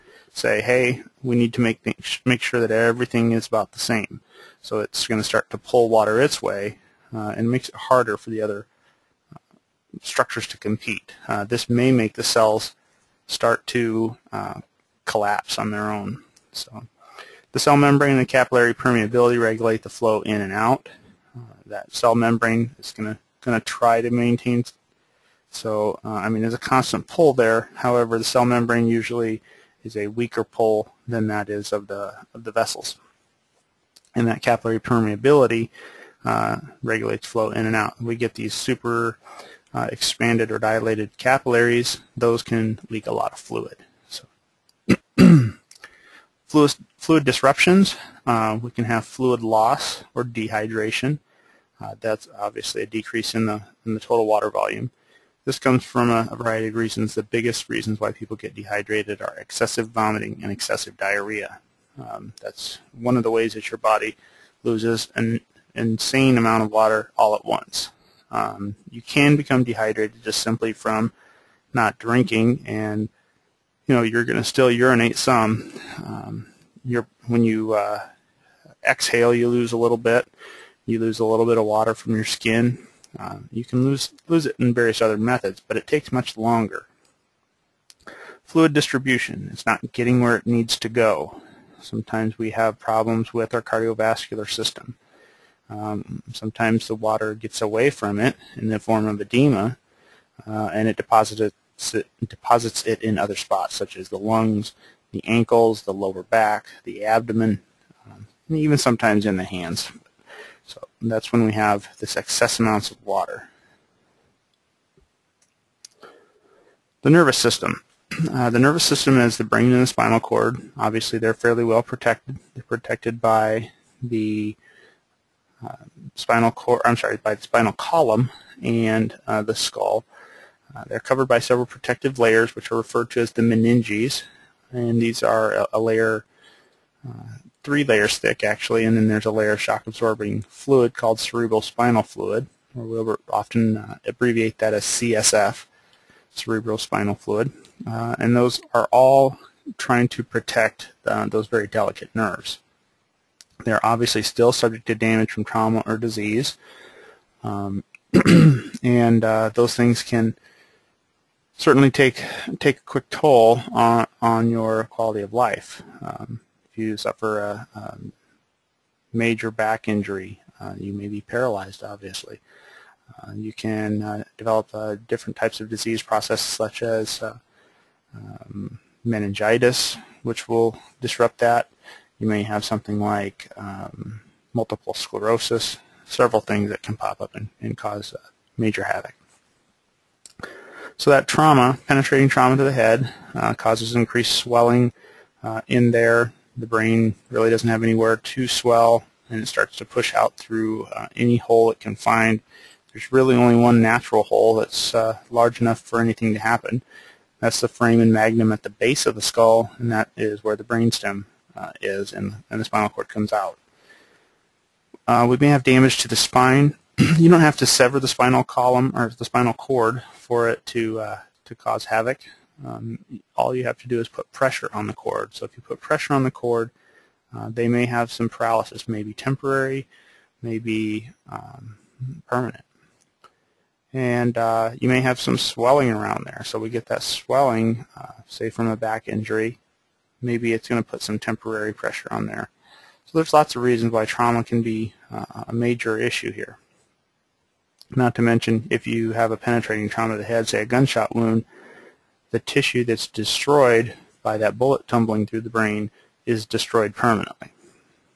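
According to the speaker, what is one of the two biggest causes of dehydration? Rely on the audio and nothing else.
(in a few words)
excessive vomiting.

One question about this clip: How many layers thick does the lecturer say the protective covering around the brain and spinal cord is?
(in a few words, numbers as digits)
3.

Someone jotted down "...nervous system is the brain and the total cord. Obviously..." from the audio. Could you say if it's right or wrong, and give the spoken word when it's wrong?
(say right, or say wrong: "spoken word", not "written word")
wrong: "spinal", not "total".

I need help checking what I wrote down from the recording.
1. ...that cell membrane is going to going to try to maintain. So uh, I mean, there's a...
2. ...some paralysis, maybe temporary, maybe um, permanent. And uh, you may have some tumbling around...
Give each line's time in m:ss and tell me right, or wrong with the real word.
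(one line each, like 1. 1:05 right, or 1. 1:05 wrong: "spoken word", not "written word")
1. 0:21 right
2. 3:48 wrong: "swelling", not "tumbling".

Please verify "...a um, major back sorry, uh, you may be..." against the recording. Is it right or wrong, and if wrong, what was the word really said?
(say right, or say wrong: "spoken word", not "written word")
wrong: "injury", not "sorry".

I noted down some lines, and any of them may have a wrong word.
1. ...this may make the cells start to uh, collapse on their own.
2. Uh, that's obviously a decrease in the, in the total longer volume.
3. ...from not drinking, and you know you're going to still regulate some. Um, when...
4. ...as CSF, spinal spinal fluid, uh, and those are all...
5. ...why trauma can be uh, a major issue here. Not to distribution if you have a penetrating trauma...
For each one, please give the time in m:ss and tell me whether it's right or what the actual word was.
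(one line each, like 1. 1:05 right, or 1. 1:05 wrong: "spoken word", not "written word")
1. 0:11 right
2. 0:51 wrong: "water", not "longer"
3. 1:10 wrong: "urinate", not "regulate"
4. 2:24 wrong: "cerebral", not "spinal"
5. 4:03 wrong: "mention", not "distribution".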